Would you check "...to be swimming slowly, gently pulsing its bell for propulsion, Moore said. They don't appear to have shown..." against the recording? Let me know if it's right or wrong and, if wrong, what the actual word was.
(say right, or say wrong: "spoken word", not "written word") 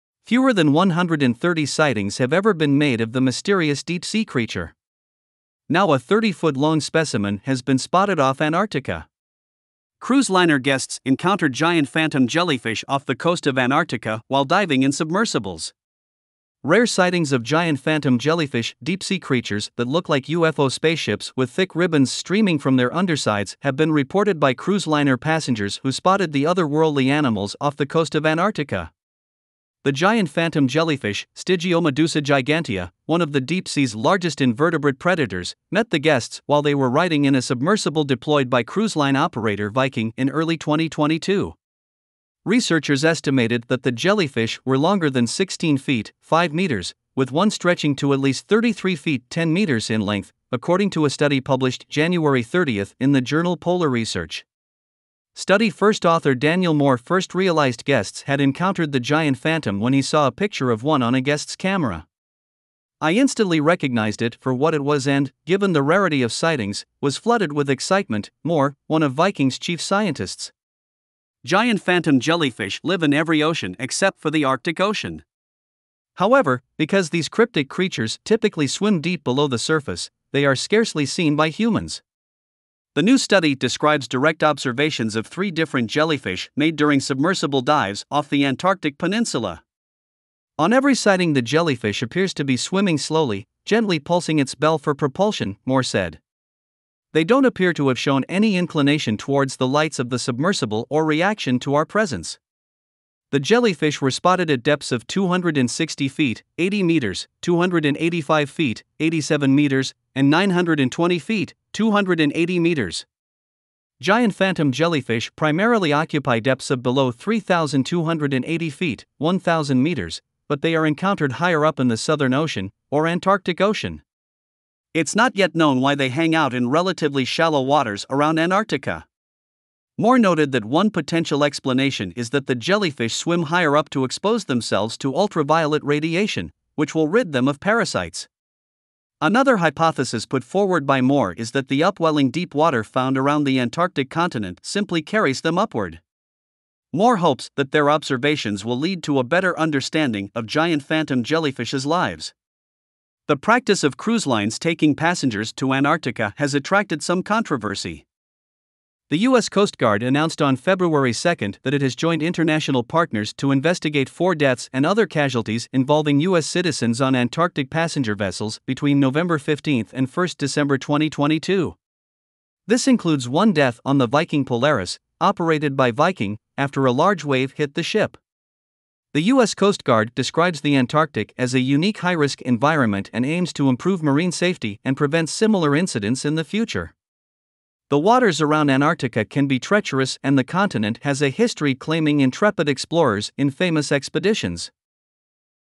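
right.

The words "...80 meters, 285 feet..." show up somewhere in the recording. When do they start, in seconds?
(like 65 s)
106 s.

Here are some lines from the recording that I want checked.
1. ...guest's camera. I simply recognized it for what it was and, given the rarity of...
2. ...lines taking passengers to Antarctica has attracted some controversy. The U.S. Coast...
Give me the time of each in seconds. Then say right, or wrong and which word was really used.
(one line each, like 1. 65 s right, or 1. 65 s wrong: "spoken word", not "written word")
1. 61 s wrong: "instantly", not "simply"
2. 154 s right.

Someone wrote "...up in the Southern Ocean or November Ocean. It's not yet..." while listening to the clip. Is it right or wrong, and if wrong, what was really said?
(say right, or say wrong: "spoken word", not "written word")
wrong: "Antarctic", not "November".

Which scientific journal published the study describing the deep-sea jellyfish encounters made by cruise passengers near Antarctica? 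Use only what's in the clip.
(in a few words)
Polar Research.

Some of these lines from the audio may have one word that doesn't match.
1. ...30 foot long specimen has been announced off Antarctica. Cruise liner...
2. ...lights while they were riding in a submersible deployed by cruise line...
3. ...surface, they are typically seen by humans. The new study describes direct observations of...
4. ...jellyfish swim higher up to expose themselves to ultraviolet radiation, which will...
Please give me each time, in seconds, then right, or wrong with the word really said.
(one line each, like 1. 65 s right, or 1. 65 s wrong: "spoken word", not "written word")
1. 5 s wrong: "spotted", not "announced"
2. 35 s wrong: "guests", not "lights"
3. 79 s wrong: "scarcely", not "typically"
4. 132 s right.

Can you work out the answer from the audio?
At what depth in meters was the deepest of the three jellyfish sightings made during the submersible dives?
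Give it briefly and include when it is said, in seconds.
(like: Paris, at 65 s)
280 meters, at 111 s.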